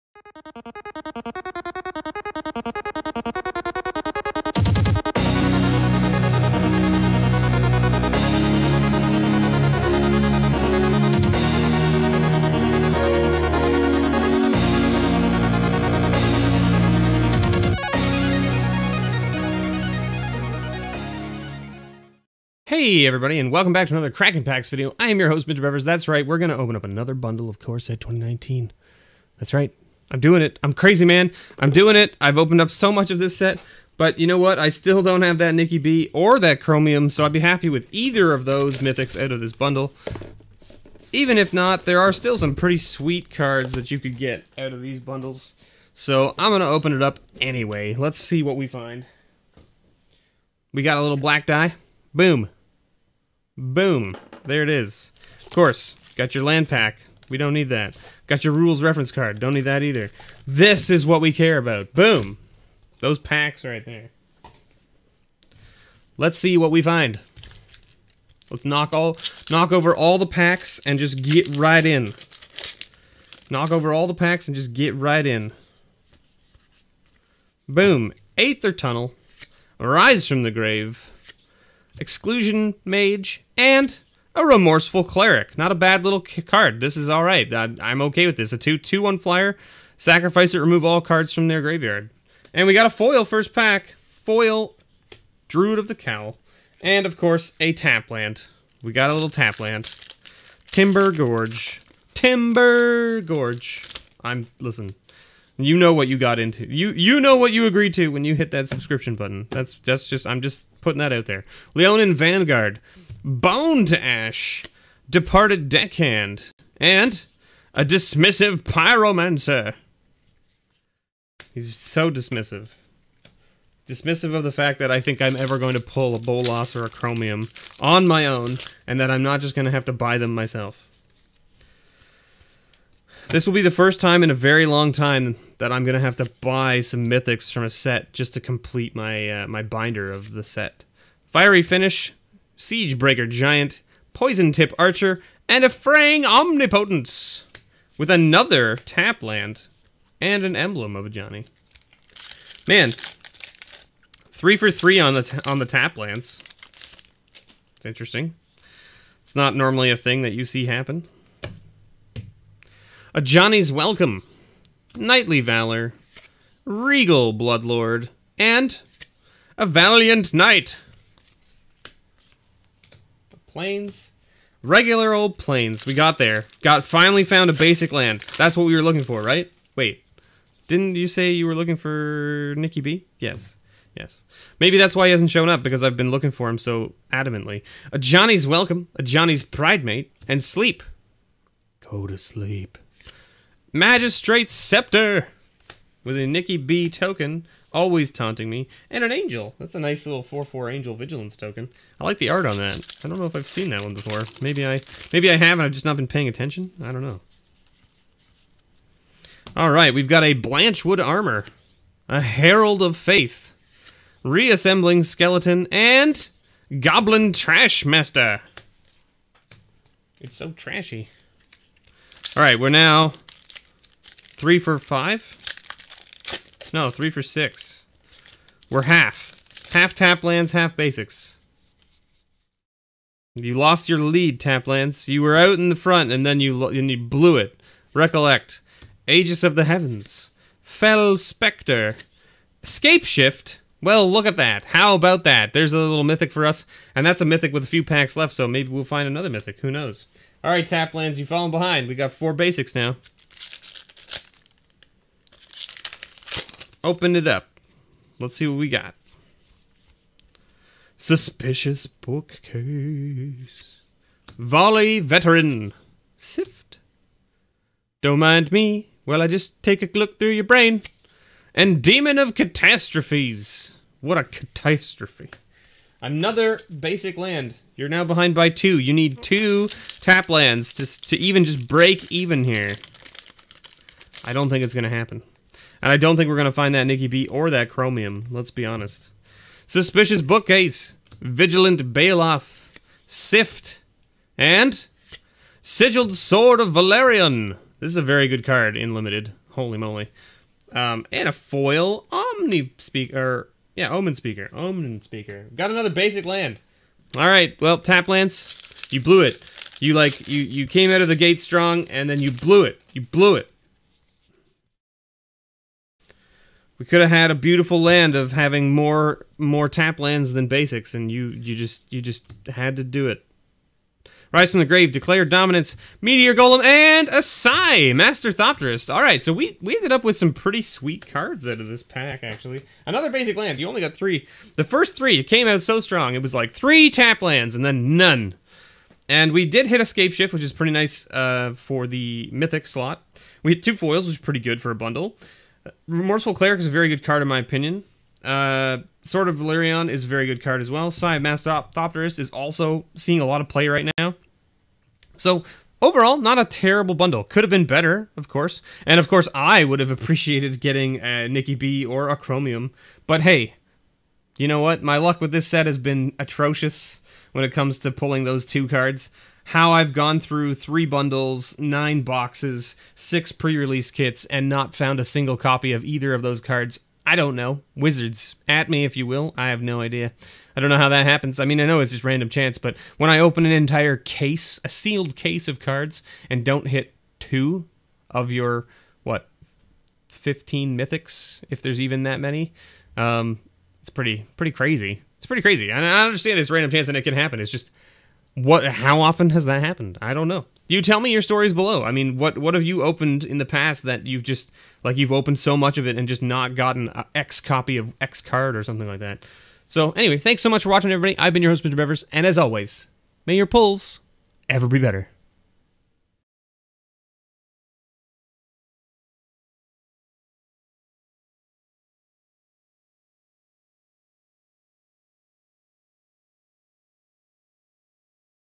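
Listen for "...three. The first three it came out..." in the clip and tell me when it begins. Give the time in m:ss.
5:33.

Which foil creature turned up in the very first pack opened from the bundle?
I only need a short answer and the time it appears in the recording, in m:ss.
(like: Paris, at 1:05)
Druid of the Cowl, at 1:34.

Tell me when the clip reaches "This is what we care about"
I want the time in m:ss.
1:00.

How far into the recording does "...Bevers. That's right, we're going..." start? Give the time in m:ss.
0:25.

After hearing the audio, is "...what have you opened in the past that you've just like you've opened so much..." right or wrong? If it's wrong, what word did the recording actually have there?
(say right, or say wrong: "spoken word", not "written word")
right.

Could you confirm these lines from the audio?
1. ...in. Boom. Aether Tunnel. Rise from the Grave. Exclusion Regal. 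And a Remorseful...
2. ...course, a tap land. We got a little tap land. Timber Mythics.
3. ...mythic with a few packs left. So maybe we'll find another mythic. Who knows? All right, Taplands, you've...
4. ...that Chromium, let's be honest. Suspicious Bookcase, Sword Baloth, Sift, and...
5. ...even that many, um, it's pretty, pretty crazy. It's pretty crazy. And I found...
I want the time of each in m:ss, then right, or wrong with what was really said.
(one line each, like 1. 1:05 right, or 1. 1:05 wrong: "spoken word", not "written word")
1. 1:15 wrong: "Mage", not "Regal"
2. 1:37 wrong: "Gorge", not "Mythics"
3. 4:07 right
4. 4:47 wrong: "Vigilant", not "Sword"
5. 6:31 wrong: "understand", not "found".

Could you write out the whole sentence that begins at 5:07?
All right, well, tap Lance, you blew it.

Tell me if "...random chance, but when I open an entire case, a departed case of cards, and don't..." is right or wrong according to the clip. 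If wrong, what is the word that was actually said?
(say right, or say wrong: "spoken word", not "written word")
wrong: "sealed", not "departed".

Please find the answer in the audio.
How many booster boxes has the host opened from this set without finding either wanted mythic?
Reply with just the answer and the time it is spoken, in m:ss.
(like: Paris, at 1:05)
9, at 6:11.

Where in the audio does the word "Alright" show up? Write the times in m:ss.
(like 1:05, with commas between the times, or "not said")
3:29, 3:42.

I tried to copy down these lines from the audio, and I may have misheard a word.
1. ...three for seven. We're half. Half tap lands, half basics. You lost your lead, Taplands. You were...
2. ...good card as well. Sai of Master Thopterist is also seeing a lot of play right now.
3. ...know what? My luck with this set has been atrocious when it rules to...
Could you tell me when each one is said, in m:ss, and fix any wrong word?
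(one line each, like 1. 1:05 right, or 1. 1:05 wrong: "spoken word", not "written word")
1. 3:46 wrong: "six", not "seven"
2. 5:50 right
3. 6:04 wrong: "comes", not "rules".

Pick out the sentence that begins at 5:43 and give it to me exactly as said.
We hit two foils, which is pretty good for a bundle.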